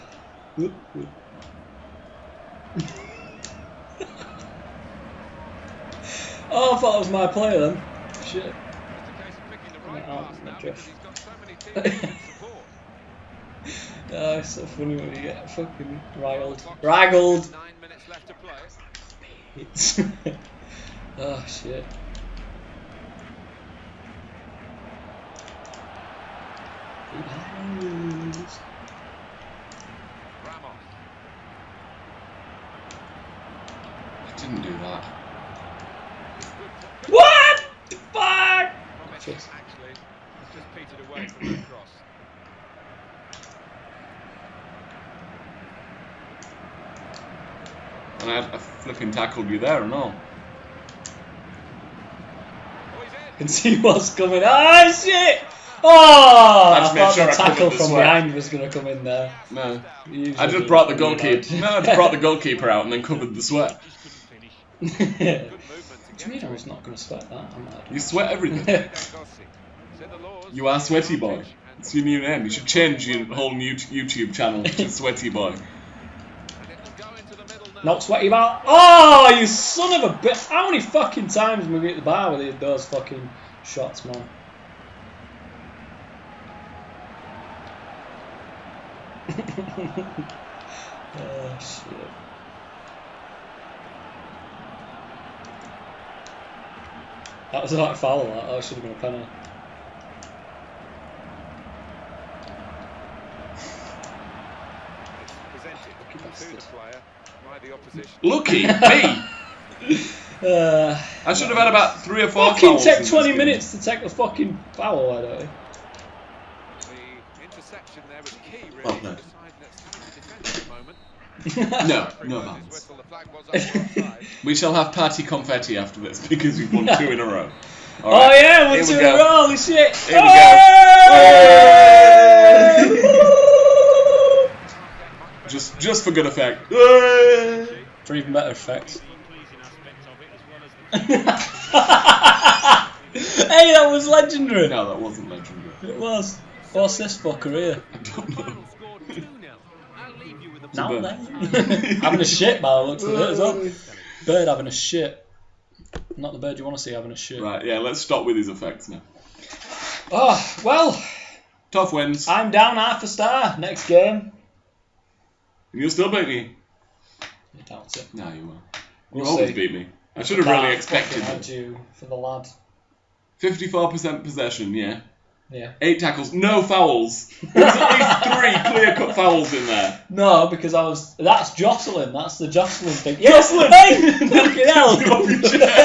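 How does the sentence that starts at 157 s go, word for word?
Right, yeah, let's stop with his effects now.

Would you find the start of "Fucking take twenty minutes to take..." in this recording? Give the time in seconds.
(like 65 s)
112 s.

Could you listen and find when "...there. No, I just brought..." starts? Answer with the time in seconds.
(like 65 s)
59 s.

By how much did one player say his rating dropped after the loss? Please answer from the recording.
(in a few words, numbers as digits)
half a star.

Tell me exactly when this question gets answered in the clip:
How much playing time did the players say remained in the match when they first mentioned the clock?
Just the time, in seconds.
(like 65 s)
17 s.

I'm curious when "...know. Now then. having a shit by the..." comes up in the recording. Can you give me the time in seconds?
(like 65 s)
150 s.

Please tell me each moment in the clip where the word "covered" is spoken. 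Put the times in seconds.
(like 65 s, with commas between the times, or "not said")
63 s.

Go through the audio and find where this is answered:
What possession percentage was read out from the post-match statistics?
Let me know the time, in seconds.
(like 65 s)
173 s.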